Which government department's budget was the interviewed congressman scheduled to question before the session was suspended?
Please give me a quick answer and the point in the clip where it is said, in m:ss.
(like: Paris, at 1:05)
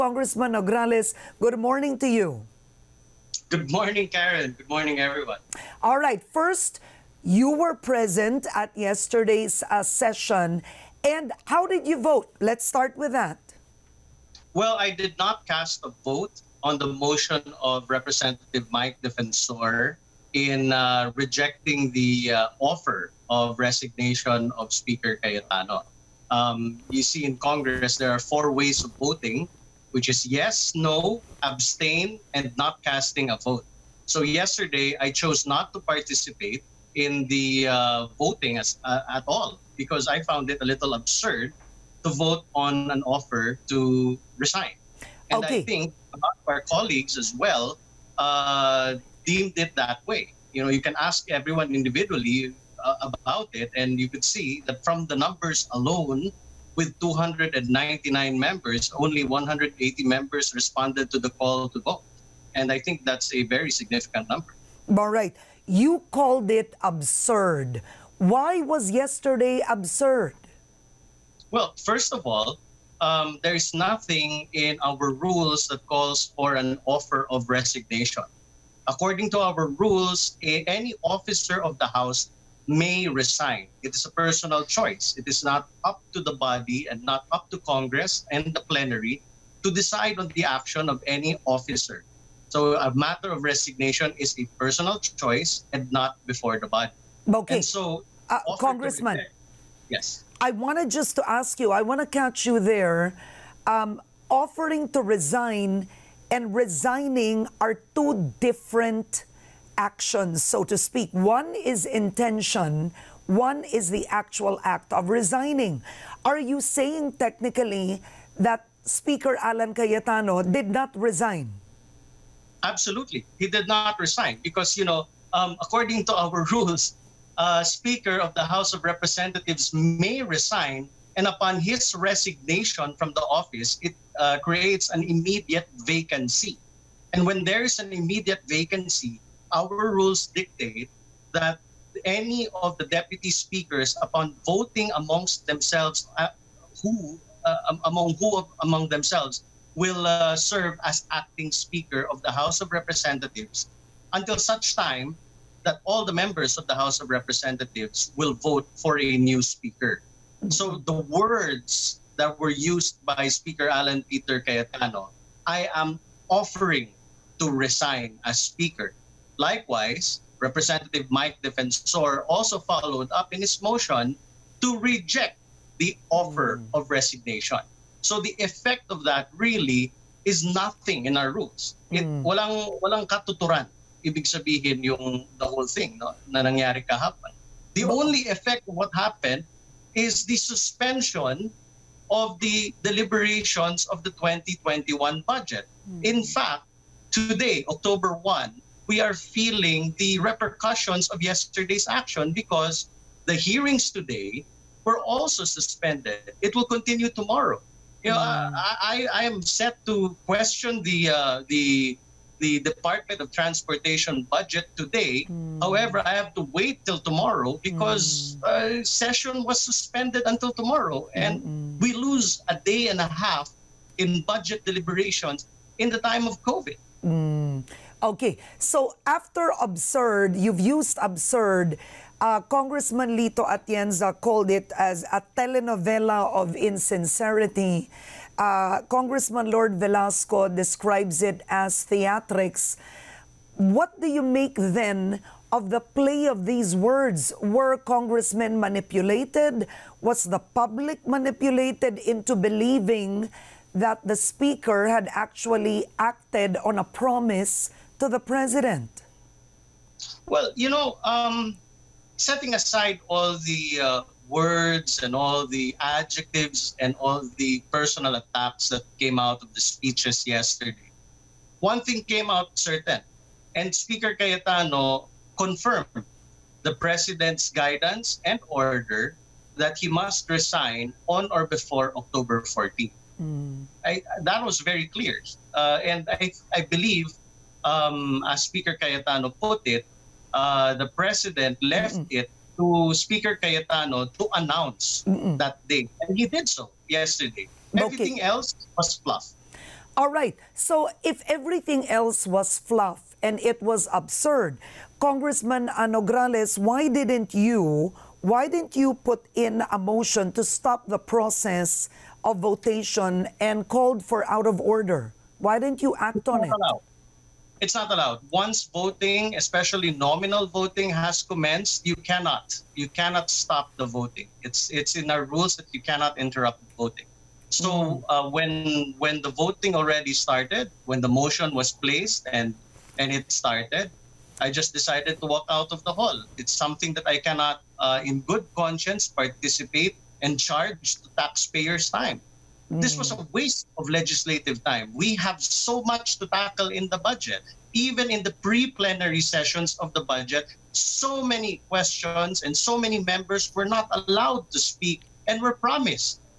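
Department of Transportation, at 3:32.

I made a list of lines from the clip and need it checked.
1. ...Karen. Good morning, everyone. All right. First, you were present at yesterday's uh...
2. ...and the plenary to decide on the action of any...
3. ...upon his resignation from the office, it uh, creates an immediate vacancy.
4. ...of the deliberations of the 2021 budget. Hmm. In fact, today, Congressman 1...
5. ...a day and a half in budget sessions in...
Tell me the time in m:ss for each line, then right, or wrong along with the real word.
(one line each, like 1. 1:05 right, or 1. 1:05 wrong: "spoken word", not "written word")
1. 0:04 right
2. 1:28 right
3. 2:11 right
4. 3:12 wrong: "October", not "Congressman"
5. 3:42 wrong: "deliberations", not "sessions".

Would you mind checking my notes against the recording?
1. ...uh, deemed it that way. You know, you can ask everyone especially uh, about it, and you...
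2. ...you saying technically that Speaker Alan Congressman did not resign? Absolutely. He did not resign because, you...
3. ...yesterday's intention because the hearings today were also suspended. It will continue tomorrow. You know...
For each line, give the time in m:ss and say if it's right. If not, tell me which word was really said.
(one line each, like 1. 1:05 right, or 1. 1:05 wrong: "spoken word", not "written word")
1. 0:48 wrong: "individually", not "especially"
2. 1:56 wrong: "Cayetano", not "Congressman"
3. 3:21 wrong: "action", not "intention".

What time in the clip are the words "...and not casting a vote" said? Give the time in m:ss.
0:32.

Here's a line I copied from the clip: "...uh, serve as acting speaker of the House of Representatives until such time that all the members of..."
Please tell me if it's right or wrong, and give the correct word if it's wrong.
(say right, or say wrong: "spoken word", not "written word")
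right.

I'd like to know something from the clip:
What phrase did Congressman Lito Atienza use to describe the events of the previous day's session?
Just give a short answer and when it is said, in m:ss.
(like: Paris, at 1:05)
telenovela of insincerity, at 3:55.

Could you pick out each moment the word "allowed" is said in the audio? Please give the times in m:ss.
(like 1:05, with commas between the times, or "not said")
5:17, 5:53.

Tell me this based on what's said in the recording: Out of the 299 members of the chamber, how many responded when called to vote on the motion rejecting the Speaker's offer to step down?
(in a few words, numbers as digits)
180.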